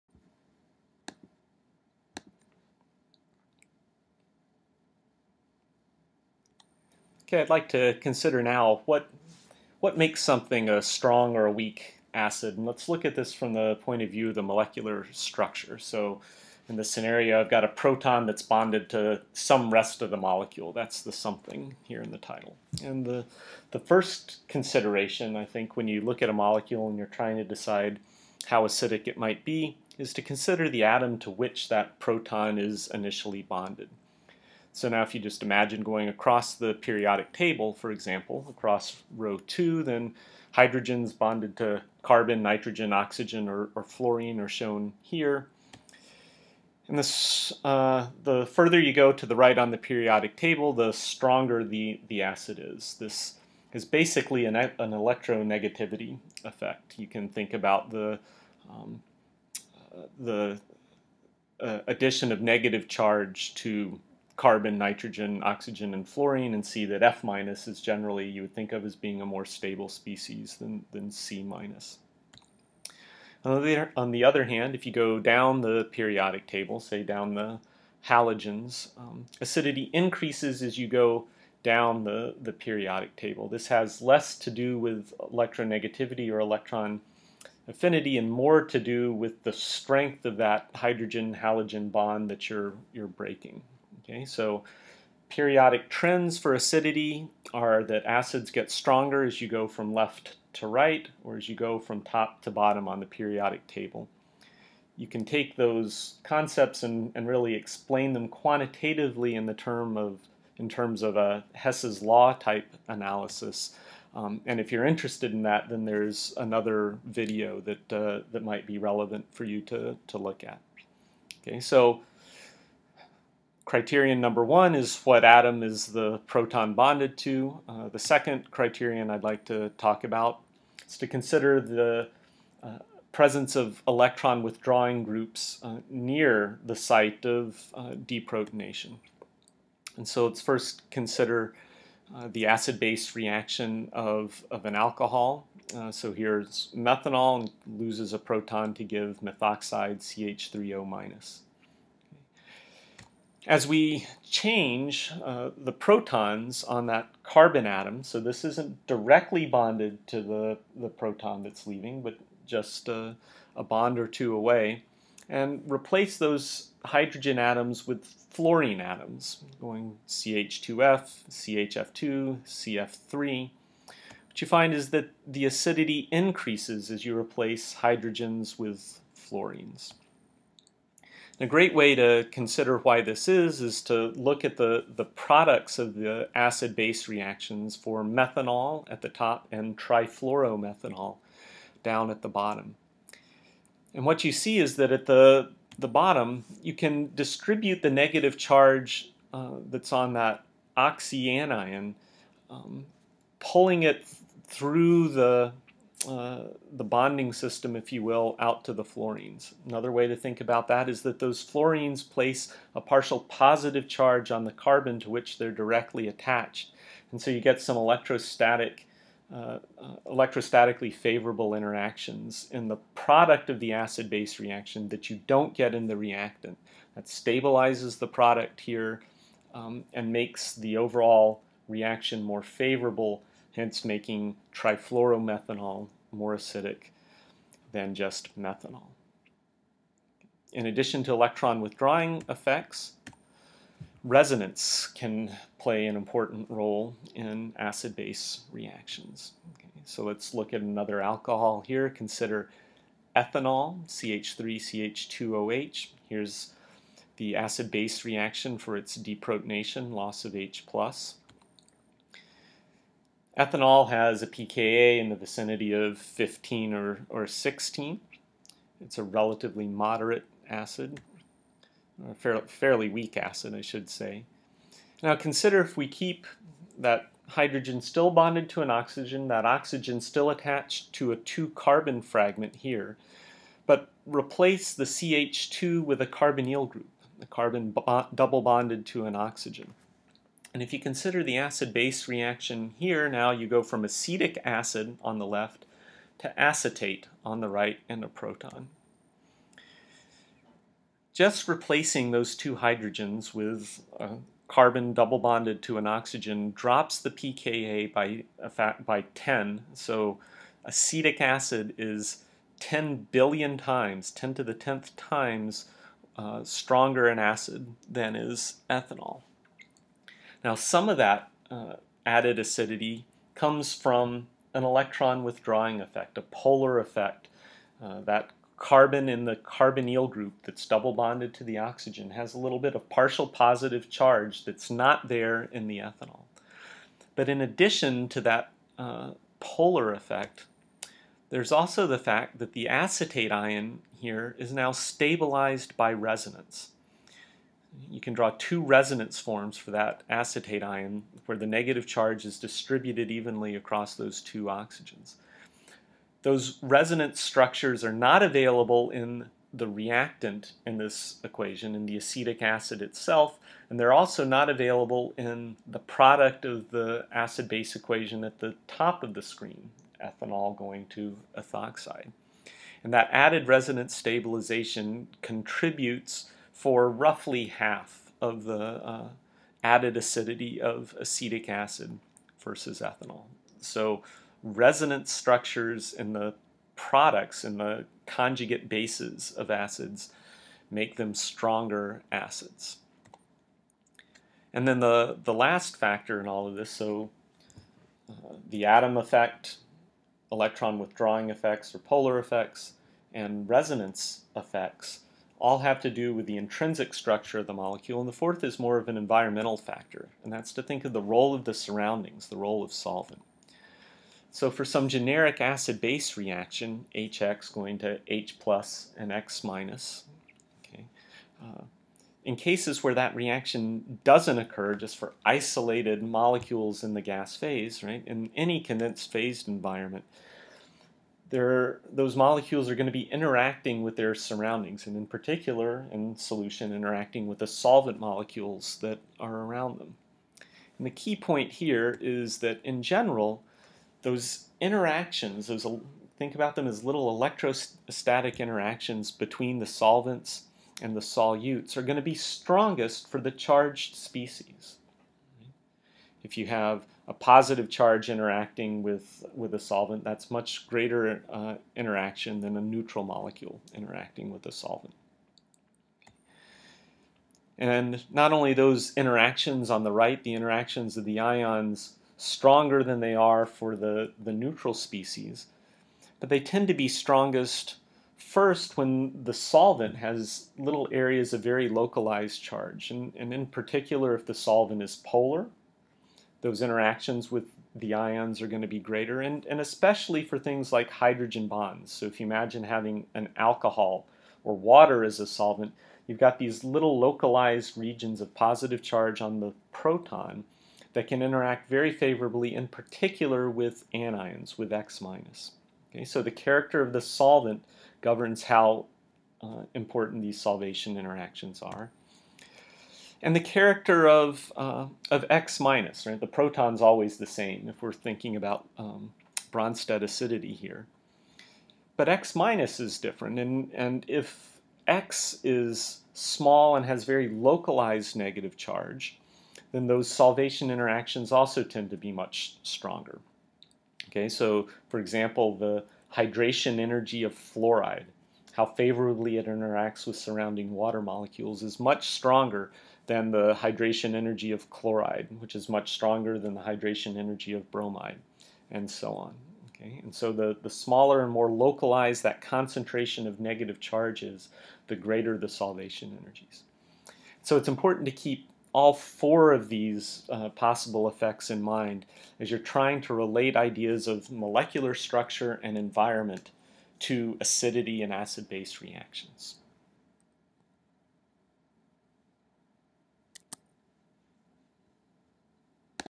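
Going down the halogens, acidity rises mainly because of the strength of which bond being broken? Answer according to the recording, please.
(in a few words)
hydrogen-halogen bond.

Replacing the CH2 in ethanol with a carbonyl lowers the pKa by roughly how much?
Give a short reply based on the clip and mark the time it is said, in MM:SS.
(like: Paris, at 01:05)
10, at 05:08.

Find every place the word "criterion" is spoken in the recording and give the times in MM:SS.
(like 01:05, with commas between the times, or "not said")
02:03, 02:08.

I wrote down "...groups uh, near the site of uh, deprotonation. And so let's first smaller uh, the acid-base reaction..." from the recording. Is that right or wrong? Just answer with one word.
wrong.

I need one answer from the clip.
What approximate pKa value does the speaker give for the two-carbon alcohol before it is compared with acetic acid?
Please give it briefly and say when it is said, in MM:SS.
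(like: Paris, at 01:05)
15 or 16, at 04:25.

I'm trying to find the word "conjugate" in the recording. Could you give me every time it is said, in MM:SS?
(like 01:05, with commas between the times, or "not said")
06:28.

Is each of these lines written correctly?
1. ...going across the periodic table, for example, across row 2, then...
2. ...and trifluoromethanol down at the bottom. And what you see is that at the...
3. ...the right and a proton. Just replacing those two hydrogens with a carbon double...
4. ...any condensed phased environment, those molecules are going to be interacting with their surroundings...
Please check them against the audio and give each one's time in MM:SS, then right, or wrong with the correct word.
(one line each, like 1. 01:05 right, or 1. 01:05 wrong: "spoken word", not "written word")
1. 00:35 right
2. 03:09 right
3. 04:57 right
4. 07:08 right.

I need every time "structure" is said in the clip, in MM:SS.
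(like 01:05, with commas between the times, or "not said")
00:15, 05:57, 06:25, 06:46, 09:24.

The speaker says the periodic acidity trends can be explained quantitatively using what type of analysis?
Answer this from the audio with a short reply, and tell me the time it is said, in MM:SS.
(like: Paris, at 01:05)
Hess's law type analysis, at 01:51.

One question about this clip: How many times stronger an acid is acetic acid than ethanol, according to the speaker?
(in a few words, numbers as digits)
10 billion.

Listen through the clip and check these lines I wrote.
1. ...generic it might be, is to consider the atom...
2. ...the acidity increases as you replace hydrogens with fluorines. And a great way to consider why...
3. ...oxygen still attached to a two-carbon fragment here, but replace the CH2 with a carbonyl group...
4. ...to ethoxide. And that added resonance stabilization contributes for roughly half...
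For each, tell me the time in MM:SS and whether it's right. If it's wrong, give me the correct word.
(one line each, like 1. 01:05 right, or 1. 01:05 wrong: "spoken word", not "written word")
1. 00:28 wrong: "acidic", not "generic"
2. 02:55 right
3. 04:39 right
4. 06:10 right.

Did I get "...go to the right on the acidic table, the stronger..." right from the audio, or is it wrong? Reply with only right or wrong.
wrong.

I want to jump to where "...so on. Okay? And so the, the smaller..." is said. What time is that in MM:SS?
09:08.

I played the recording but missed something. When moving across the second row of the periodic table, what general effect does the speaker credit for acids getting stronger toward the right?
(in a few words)
electronegativity effect.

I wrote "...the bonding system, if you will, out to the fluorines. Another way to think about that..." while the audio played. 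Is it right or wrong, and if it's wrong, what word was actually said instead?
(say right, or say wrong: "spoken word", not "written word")
right.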